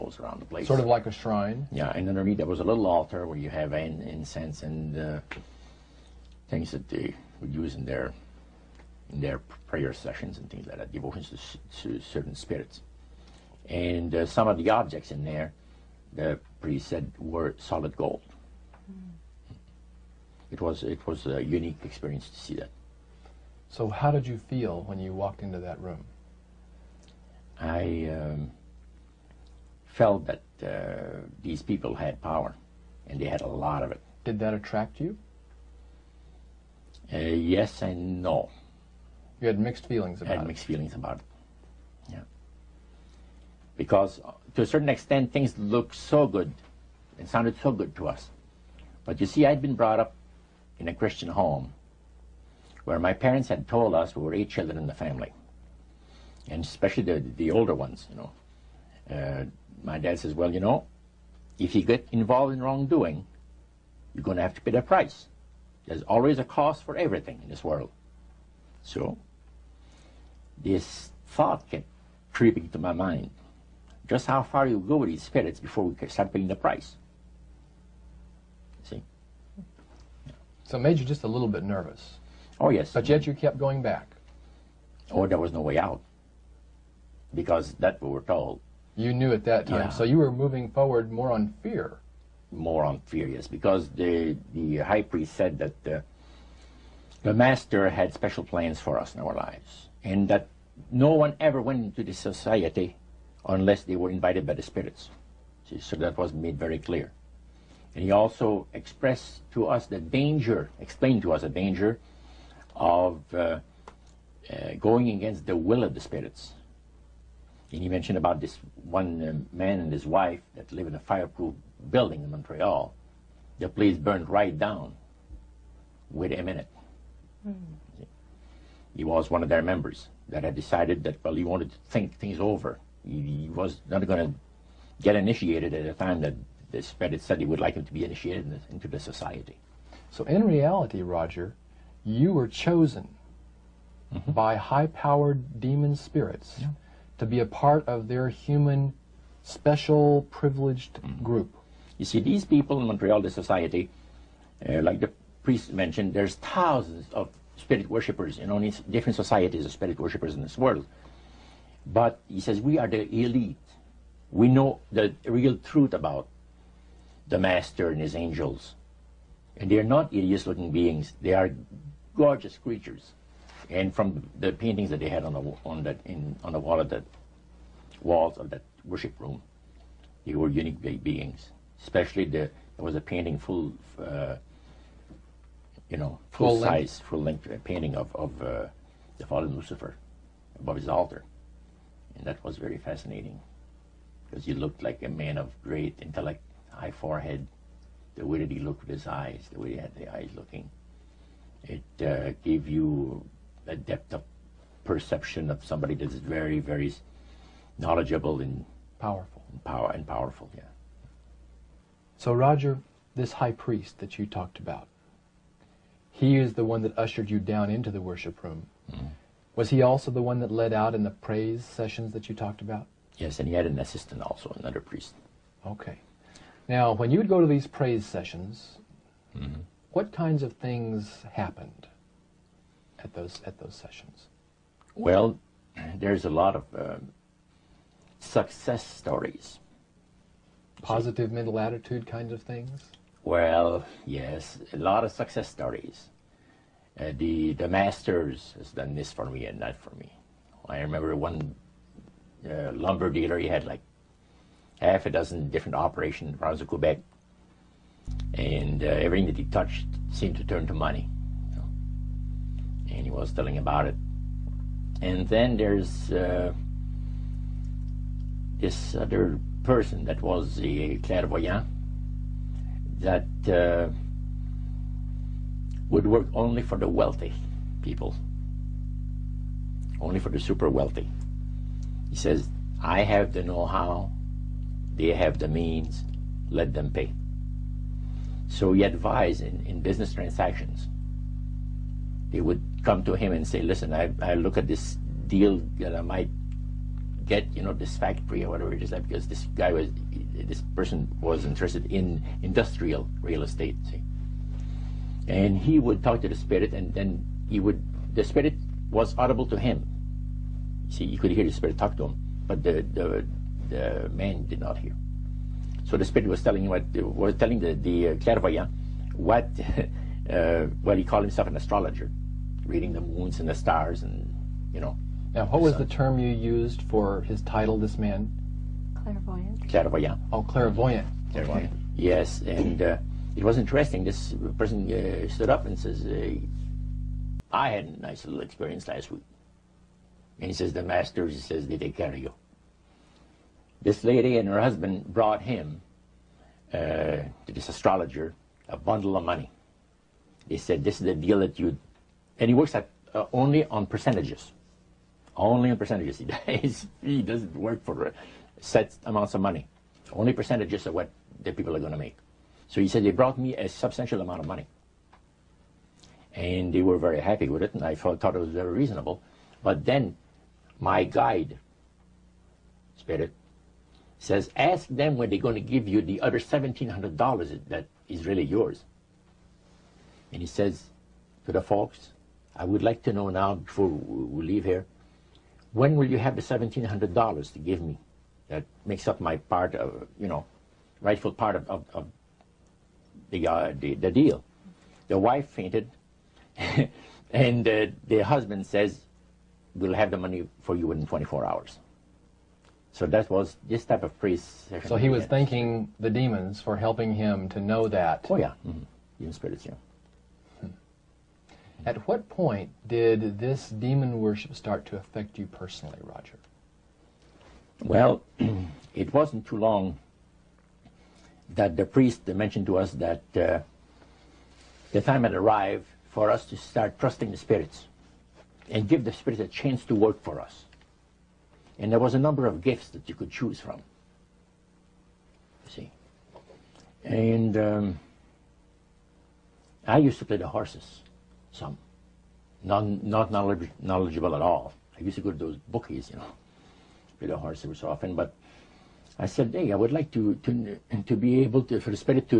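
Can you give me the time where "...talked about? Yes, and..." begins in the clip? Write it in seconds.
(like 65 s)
222 s.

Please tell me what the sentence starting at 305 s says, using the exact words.
And he would talk to the spirit and then he would, the spirit was audible to him.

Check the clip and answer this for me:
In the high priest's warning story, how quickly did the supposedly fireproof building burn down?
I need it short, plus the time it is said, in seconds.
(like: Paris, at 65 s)
Within a minute, at 126 s.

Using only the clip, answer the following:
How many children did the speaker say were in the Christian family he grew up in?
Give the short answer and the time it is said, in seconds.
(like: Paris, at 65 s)
8, at 54 s.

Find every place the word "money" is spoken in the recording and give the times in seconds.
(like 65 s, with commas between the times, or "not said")
260 s, 349 s, 359 s, 364 s, 400 s.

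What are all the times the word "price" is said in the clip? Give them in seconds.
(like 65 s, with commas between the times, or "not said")
64 s, 76 s.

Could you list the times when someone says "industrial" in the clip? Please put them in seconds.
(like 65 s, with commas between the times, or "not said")
302 s.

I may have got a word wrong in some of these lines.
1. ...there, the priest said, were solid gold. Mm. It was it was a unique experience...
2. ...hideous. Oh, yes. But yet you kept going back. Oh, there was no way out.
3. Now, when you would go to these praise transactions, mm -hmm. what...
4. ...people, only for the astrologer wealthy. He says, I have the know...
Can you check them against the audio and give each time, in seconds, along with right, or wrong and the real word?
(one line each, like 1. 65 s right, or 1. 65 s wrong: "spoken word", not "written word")
1. 15 s right
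2. 81 s wrong: "nervous", not "hideous"
3. 226 s wrong: "sessions", not "transactions"
4. 277 s wrong: "super", not "astrologer".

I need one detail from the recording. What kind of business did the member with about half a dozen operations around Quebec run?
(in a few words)
Lumber.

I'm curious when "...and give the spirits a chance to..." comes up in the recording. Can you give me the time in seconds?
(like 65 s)
428 s.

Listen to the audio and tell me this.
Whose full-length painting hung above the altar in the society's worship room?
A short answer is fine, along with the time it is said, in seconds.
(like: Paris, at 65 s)
Lucifer, at 189 s.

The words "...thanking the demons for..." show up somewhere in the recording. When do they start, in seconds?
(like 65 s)
405 s.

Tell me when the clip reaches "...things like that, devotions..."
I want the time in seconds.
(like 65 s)
10 s.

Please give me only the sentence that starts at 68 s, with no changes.
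So, this thought kept creeping to my mind.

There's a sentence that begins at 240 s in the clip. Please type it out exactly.
Positive mental attitude kinds of things.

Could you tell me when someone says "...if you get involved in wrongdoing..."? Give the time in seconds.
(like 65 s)
61 s.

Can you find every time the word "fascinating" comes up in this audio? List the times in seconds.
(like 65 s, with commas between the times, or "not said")
192 s.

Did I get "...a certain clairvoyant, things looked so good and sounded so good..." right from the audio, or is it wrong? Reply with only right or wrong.
wrong.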